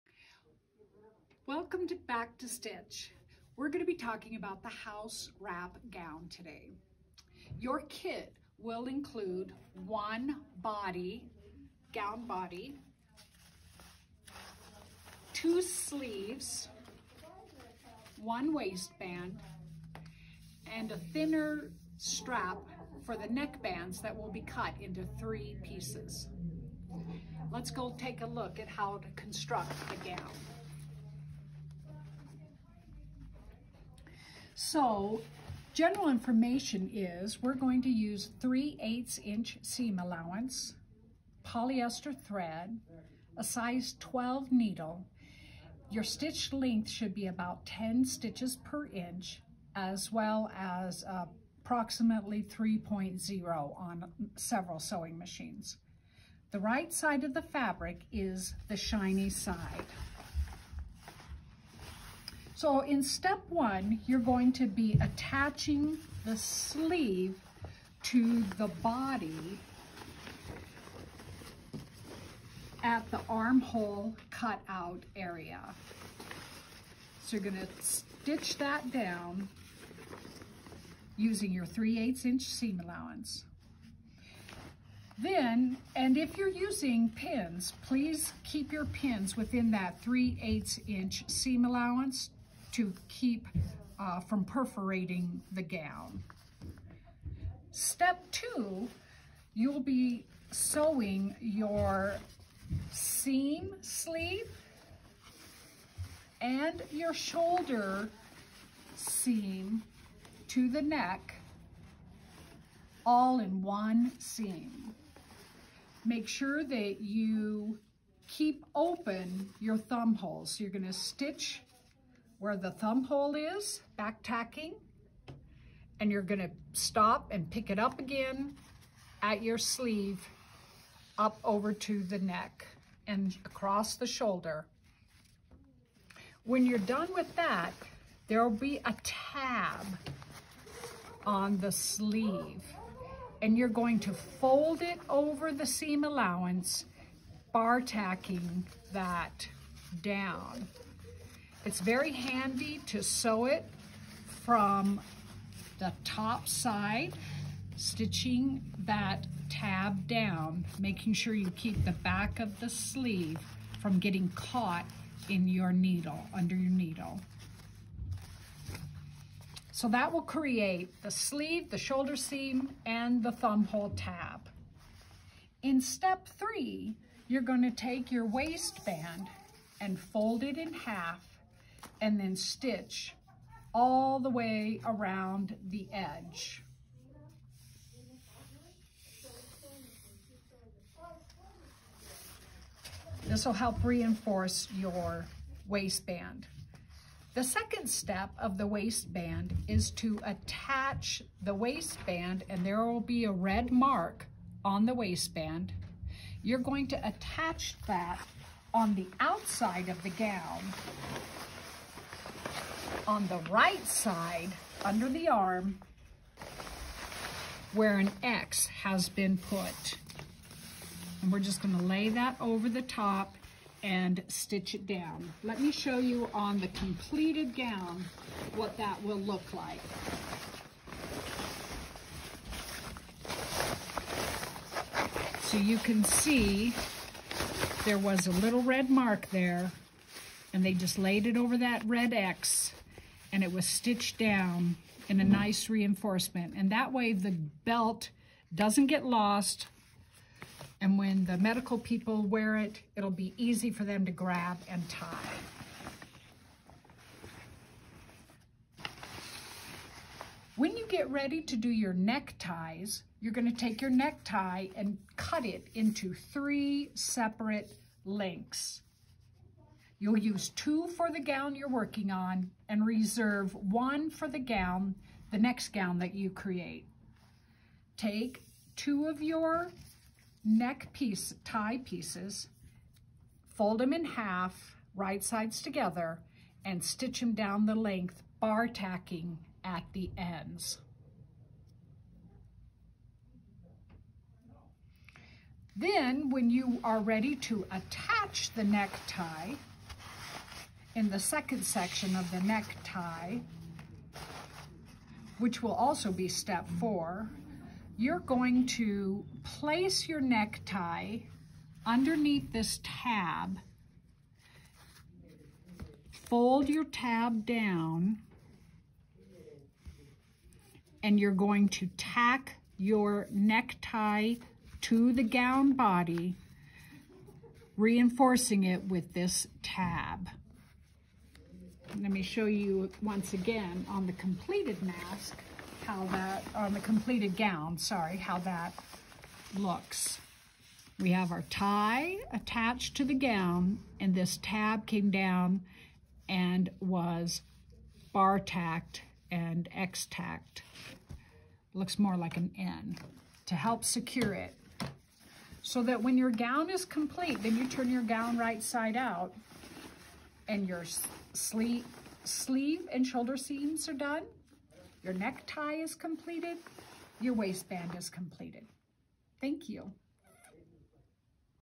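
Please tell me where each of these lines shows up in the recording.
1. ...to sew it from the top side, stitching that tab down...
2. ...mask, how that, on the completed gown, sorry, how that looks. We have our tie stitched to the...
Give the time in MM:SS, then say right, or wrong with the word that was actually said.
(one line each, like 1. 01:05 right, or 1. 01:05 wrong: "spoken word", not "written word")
1. 02:32 right
2. 05:34 wrong: "attached", not "stitched".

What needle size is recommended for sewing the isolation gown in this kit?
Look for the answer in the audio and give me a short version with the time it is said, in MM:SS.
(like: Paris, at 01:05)
size 12, at 00:43.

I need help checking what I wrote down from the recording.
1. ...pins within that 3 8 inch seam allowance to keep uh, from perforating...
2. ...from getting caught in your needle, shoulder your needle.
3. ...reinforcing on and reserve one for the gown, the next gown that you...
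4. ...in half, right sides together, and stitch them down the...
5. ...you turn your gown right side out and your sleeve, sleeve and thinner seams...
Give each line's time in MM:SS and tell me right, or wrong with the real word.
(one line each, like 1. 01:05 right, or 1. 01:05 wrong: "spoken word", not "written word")
1. 01:28 right
2. 02:43 wrong: "under", not "shoulder"
3. 04:31 wrong: "working", not "reinforcing"
4. 04:43 right
5. 05:57 wrong: "shoulder", not "thinner".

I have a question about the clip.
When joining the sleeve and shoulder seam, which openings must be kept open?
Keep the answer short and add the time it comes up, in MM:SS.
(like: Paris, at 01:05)
thumb holes, at 01:59.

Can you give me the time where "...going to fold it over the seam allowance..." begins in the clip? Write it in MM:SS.
02:23.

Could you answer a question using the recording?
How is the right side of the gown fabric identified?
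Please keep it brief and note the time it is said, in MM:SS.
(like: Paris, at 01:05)
the shiny side, at 00:58.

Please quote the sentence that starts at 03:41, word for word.
And we're just gonna lay that over the top and stitch it down.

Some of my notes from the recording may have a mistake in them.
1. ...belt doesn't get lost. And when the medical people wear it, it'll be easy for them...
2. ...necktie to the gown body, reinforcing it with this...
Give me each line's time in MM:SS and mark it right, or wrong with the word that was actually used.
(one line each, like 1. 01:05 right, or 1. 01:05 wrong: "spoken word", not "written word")
1. 04:07 right
2. 05:23 right.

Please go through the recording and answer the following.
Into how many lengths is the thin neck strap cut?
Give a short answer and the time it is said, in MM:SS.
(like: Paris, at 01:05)
3, at 04:26.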